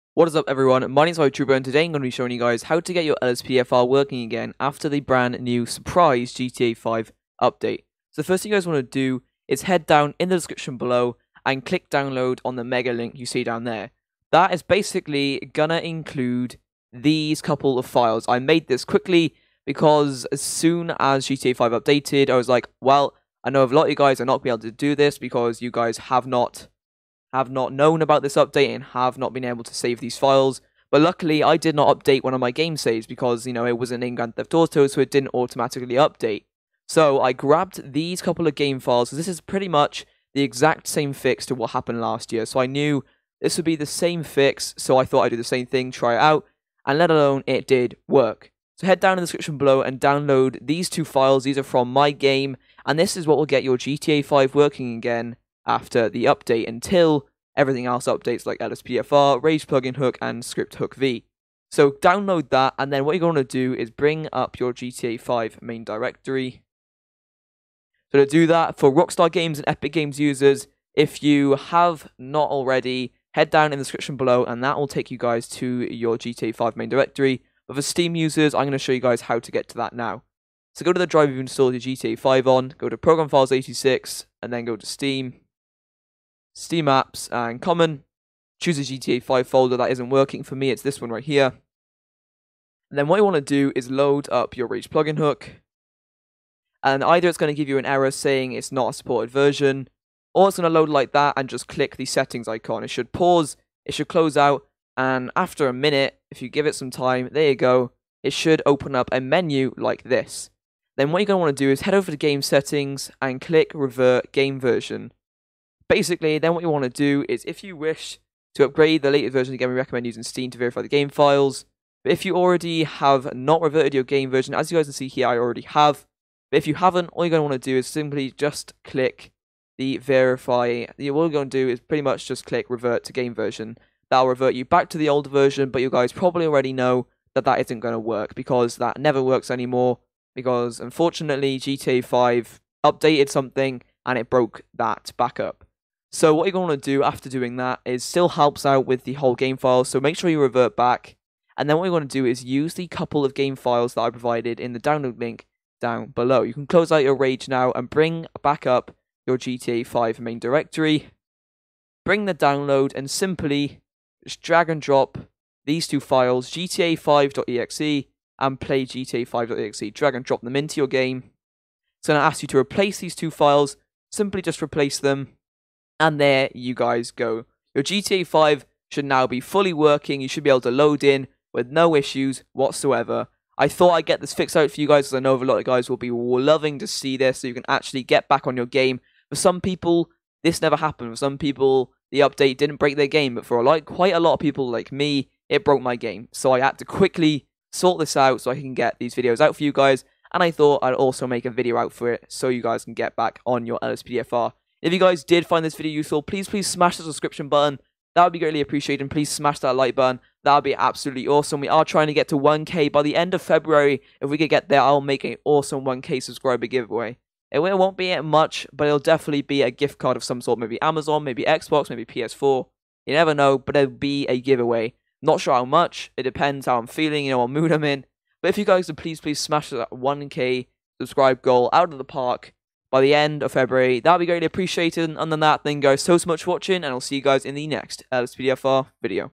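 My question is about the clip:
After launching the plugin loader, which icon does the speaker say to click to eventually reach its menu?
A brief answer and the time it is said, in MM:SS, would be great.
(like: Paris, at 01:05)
settings icon, at 01:42.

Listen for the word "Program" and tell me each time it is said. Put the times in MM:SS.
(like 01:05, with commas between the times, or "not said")
01:22.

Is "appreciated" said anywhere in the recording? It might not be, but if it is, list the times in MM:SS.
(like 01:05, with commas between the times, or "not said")
03:28, 03:54.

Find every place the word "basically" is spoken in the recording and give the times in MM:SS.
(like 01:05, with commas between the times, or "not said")
00:14, 01:55.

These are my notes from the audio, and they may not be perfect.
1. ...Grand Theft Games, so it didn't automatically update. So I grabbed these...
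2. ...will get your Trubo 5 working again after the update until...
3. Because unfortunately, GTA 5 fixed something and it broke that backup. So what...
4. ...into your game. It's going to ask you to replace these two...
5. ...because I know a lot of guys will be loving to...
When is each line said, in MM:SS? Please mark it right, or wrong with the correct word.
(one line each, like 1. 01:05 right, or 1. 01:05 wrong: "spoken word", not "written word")
1. 00:34 wrong: "Auto", not "Games"
2. 00:53 wrong: "GTA", not "Trubo"
3. 02:20 wrong: "updated", not "fixed"
4. 02:50 right
5. 03:05 right.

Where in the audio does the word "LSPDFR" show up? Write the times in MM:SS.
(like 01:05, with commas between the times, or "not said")
00:03, 00:58, 03:23.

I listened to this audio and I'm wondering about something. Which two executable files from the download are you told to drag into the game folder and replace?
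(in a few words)
gta5.exe and playgta5.exe.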